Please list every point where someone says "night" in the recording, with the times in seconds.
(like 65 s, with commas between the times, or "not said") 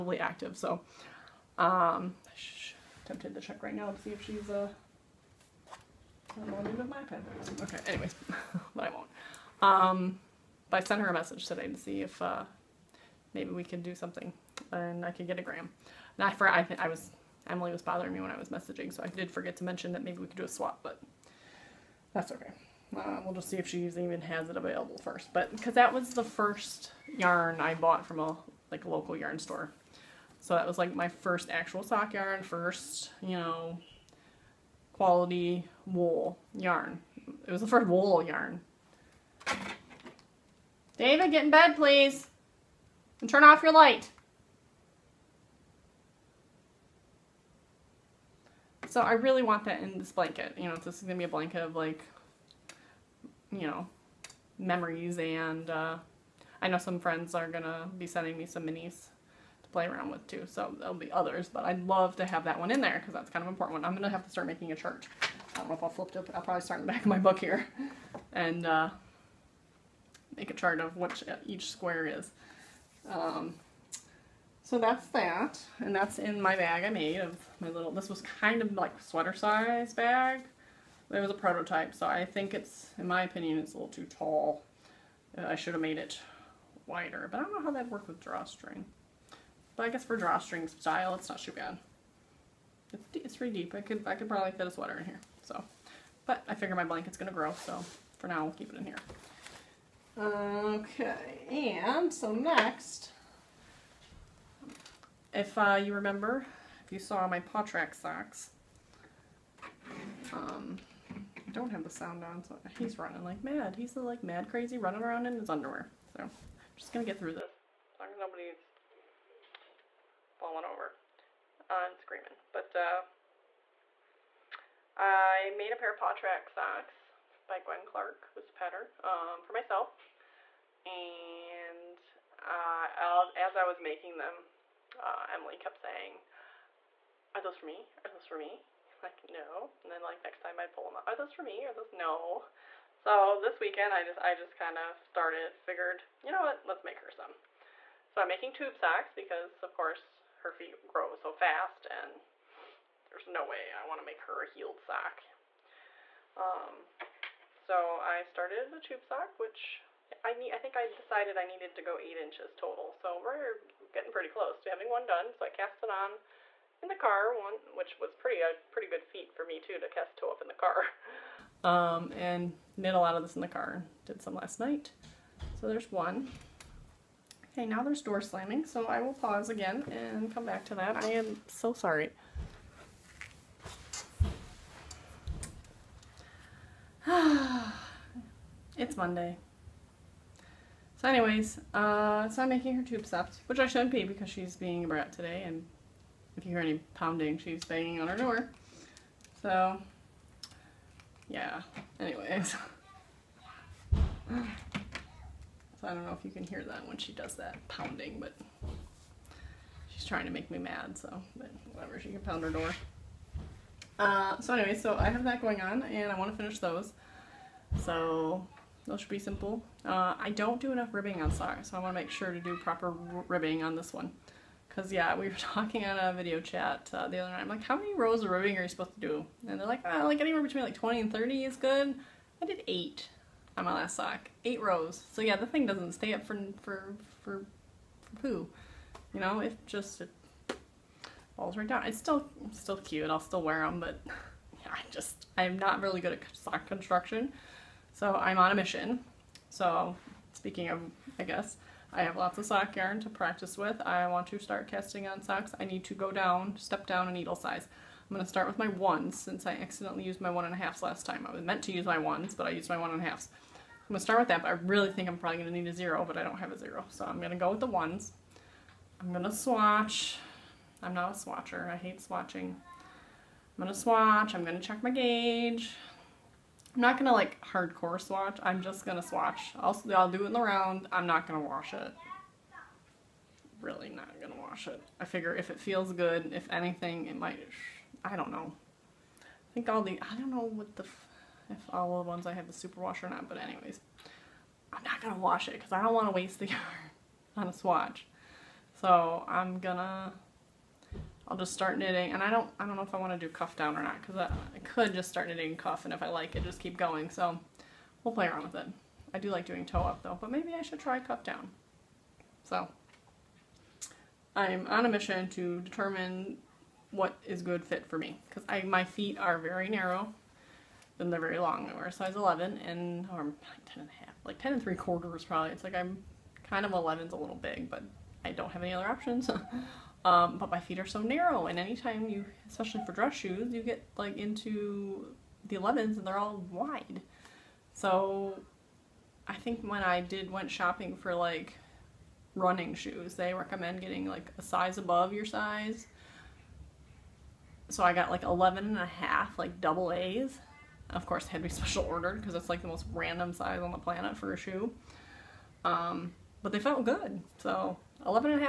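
174 s, 227 s.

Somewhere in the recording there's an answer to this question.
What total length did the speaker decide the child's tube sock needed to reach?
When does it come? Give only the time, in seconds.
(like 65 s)
161 s.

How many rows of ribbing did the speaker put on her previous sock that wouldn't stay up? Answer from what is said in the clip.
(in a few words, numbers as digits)
8.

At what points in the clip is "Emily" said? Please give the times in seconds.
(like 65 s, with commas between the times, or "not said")
17 s, 135 s.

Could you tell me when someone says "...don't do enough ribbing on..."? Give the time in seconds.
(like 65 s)
220 s.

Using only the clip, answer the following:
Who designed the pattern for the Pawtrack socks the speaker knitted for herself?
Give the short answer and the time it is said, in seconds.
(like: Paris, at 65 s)
Gwen Clark, at 127 s.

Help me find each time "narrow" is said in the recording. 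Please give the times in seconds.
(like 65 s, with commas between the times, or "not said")
319 s, 331 s.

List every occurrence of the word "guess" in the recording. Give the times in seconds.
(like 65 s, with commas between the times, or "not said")
89 s, 251 s.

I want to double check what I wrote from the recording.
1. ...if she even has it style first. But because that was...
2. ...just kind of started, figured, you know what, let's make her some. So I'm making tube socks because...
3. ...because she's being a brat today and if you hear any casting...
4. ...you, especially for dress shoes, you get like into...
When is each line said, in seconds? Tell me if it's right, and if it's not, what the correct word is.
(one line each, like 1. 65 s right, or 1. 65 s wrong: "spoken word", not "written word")
1. 23 s wrong: "available", not "style"
2. 144 s right
3. 194 s wrong: "pounding", not "casting"
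4. 332 s right.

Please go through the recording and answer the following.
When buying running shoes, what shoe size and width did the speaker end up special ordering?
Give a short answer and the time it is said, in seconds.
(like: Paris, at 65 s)
11 and a half AA, at 348 s.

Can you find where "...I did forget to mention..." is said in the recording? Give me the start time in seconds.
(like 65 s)
19 s.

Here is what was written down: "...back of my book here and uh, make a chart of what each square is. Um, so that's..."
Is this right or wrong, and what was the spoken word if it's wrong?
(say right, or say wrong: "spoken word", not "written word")
right.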